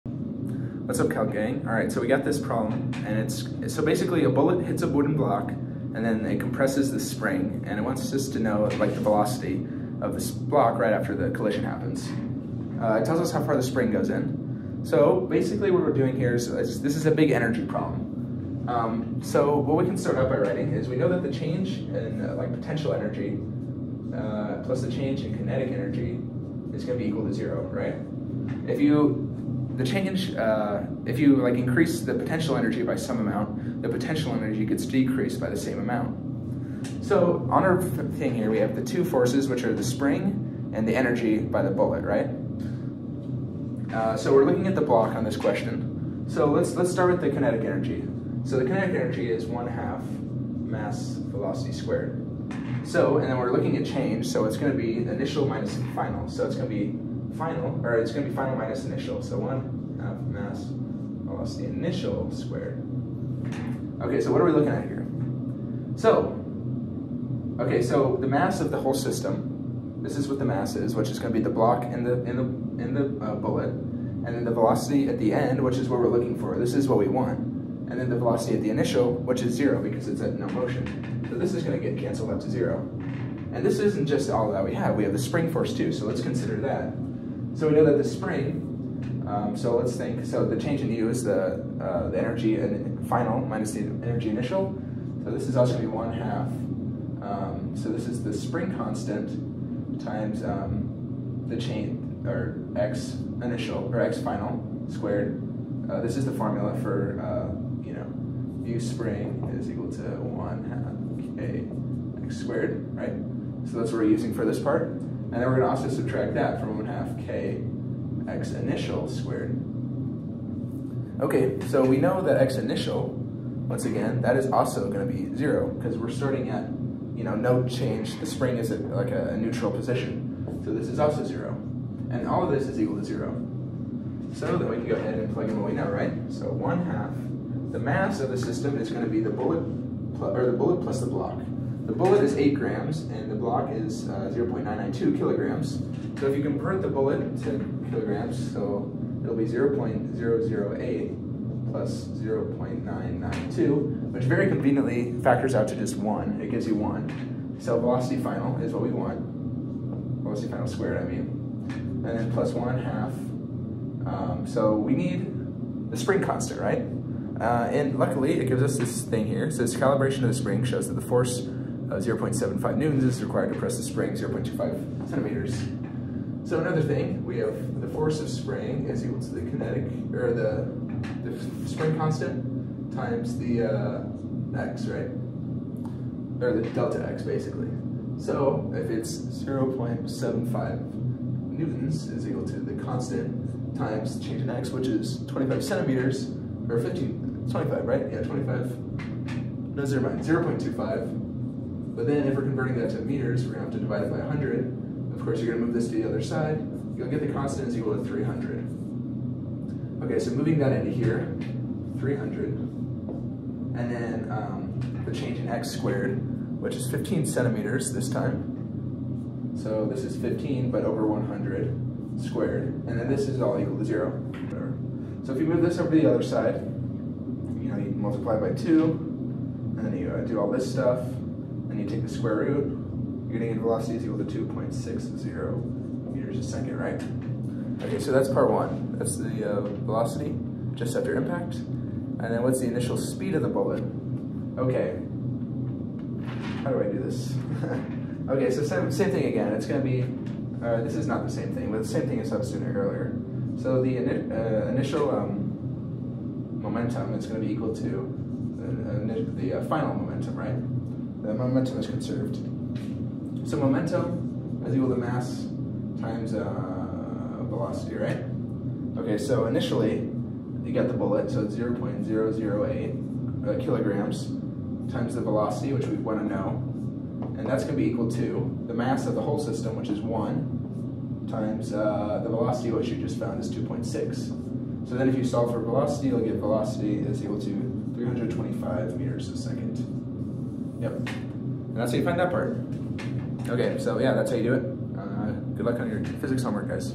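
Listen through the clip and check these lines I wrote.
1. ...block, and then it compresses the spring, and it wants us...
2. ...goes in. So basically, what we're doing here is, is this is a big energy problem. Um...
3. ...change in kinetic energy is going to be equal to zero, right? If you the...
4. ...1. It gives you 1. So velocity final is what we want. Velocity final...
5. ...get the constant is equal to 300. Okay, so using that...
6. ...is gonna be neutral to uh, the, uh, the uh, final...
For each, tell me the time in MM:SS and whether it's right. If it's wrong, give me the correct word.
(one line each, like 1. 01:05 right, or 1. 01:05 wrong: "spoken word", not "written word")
1. 00:05 right
2. 00:13 right
3. 00:24 right
4. 02:35 right
5. 03:27 wrong: "moving", not "using"
6. 04:17 wrong: "equal", not "neutral".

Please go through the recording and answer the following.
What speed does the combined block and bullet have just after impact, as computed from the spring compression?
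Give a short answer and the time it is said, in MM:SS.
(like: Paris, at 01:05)
2.60 m/s, at 03:54.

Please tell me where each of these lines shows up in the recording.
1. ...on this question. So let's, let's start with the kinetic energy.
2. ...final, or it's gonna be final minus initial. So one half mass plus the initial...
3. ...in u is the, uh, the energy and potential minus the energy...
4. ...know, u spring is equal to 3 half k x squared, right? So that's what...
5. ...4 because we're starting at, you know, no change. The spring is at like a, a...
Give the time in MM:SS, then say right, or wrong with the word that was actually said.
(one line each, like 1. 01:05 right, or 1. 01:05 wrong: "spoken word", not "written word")
1. 00:45 right
2. 00:57 right
3. 01:30 wrong: "final", not "potential"
4. 01:47 wrong: "1", not "3"
5. 02:05 wrong: "0", not "4".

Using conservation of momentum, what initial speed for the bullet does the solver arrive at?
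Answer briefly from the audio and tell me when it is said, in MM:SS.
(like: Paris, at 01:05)
325 m/s, at 04:47.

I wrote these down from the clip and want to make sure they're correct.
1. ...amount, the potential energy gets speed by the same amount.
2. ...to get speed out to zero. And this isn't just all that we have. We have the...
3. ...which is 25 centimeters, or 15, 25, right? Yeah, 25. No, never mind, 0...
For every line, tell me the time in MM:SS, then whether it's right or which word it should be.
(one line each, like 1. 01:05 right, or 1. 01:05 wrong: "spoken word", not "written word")
1. 00:33 wrong: "decreased", not "speed"
2. 01:21 wrong: "canceled", not "speed"
3. 03:14 right.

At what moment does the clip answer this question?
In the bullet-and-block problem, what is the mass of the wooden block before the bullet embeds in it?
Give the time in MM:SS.
02:24.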